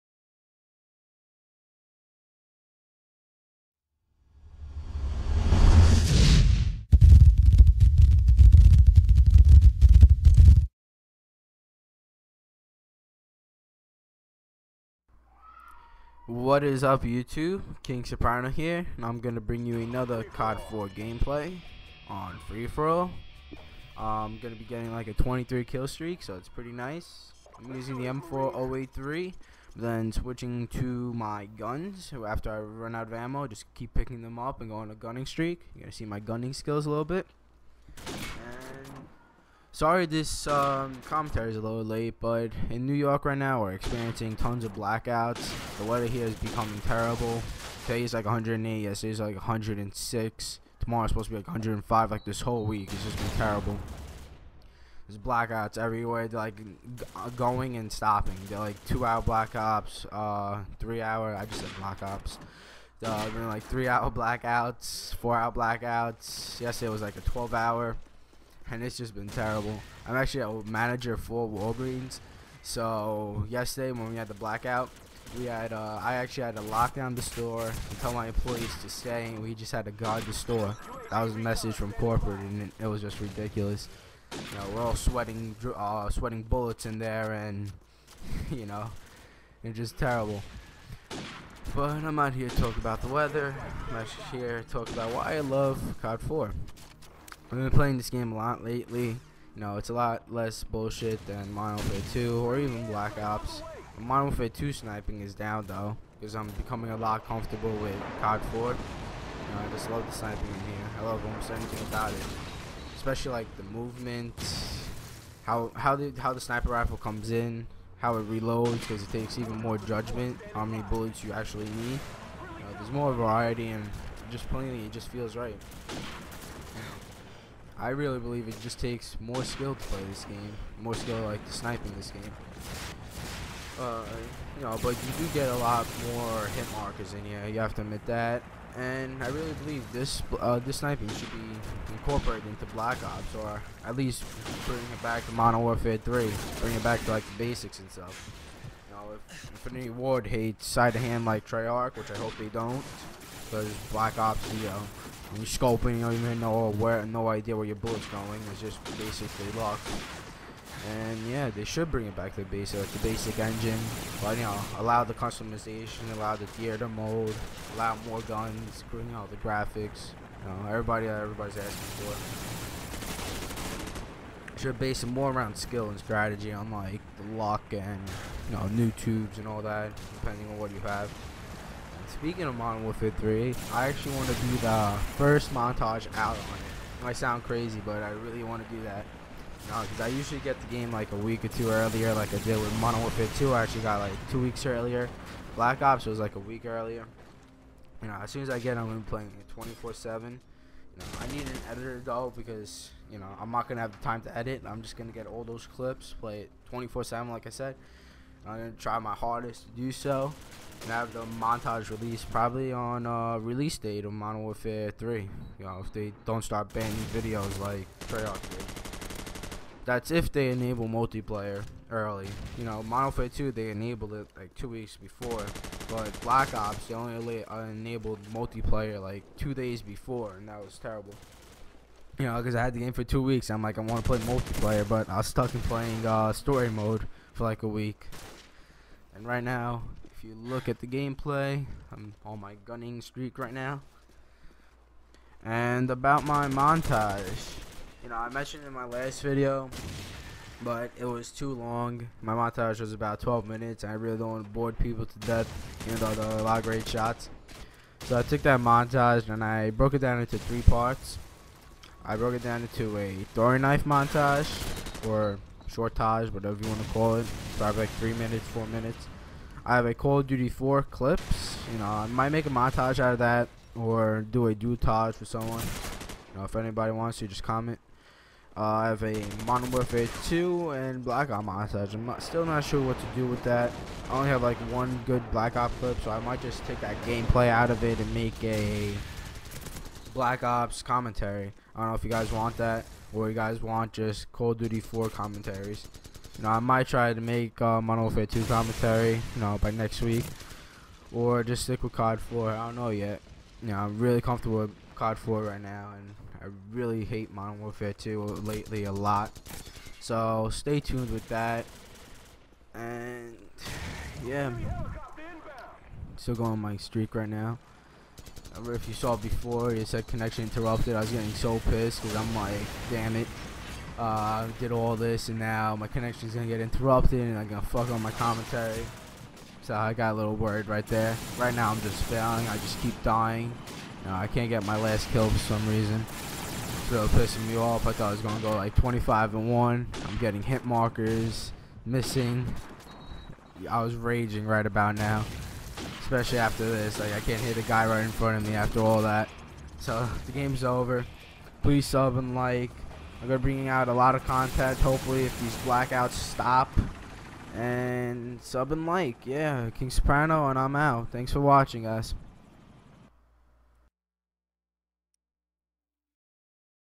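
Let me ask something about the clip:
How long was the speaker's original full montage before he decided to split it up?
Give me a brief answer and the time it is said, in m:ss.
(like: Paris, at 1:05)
12 minutes, at 4:13.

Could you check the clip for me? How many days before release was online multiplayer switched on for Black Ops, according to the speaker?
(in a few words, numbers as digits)
2 days.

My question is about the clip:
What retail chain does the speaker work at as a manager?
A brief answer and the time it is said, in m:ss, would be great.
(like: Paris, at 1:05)
Walgreens, at 1:11.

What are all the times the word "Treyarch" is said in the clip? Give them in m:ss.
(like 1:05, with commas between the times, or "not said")
2:31, 3:38.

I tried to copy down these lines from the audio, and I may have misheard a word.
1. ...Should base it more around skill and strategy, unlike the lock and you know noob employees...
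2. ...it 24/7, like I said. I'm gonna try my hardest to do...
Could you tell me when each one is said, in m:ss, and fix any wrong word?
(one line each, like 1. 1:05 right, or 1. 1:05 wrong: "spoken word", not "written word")
1. 2:54 wrong: "tubes", not "employees"
2. 3:26 right.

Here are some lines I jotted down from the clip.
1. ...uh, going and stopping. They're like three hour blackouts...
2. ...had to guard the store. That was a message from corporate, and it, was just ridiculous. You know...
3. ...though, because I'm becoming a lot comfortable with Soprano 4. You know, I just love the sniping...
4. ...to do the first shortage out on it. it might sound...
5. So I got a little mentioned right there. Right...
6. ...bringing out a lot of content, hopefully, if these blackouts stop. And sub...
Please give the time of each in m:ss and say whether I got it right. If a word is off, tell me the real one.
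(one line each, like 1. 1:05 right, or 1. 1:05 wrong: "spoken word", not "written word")
1. 0:57 wrong: "two", not "three"
2. 1:19 right
3. 1:45 wrong: "COD", not "Soprano"
4. 3:04 wrong: "montage", not "shortage"
5. 5:29 wrong: "worried", not "mentioned"
6. 5:53 right.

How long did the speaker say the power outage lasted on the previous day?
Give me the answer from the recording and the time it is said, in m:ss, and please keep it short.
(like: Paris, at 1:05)
12 hour, at 1:07.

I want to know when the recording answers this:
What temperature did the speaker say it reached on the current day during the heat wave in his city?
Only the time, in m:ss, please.
0:48.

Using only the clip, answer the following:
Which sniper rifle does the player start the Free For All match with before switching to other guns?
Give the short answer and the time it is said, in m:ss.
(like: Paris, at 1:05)
M40A3, at 0:28.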